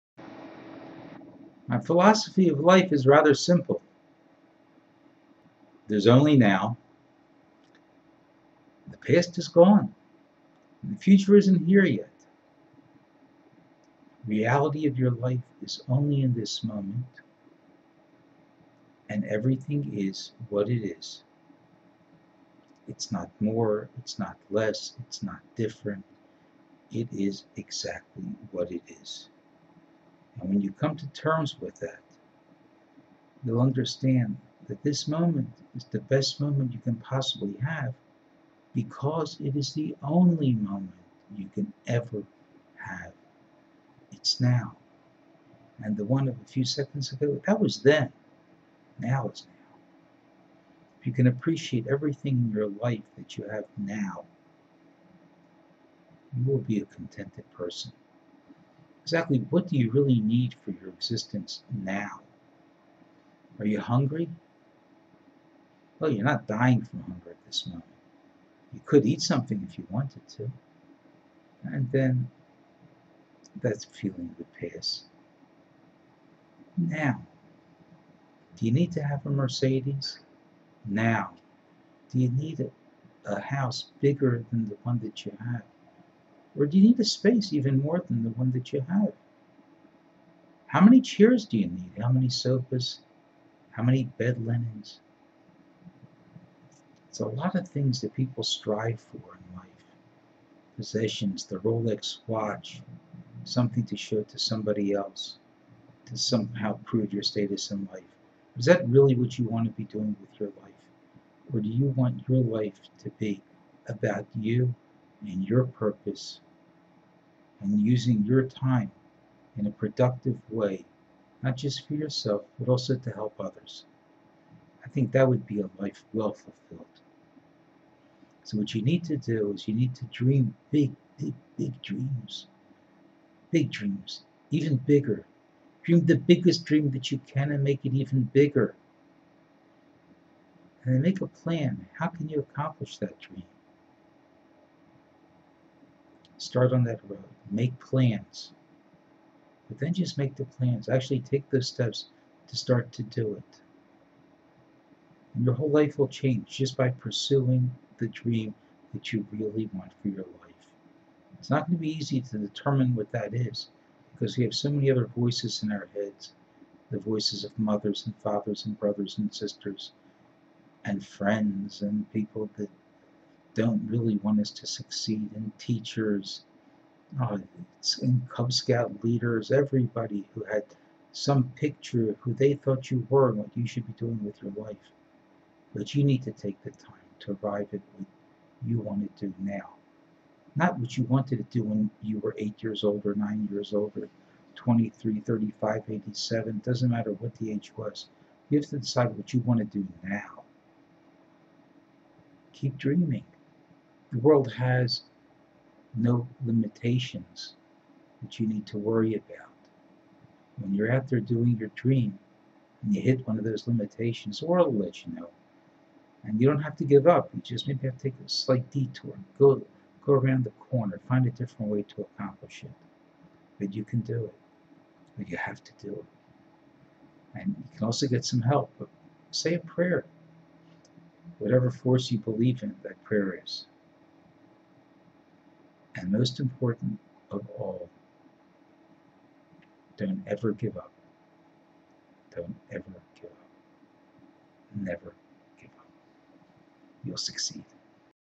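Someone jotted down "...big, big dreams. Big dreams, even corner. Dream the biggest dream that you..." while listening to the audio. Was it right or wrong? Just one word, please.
wrong.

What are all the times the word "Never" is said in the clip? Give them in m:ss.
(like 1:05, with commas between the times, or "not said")
4:04.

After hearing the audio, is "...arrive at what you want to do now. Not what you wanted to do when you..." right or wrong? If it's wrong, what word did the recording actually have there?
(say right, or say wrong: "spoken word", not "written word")
right.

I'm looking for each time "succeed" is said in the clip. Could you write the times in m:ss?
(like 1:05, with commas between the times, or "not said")
2:54, 4:07.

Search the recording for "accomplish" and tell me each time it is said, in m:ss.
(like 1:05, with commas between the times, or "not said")
2:22, 3:42.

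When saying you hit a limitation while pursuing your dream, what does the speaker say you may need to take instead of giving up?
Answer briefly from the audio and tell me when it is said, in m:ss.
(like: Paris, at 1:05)
a slight detour, at 3:38.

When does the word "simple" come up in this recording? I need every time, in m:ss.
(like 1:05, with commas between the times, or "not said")
0:03.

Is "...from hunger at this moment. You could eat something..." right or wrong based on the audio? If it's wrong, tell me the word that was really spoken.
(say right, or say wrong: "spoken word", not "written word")
right.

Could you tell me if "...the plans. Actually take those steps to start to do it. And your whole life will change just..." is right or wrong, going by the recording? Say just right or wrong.
right.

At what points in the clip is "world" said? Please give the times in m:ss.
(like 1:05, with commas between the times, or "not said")
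3:24, 3:34.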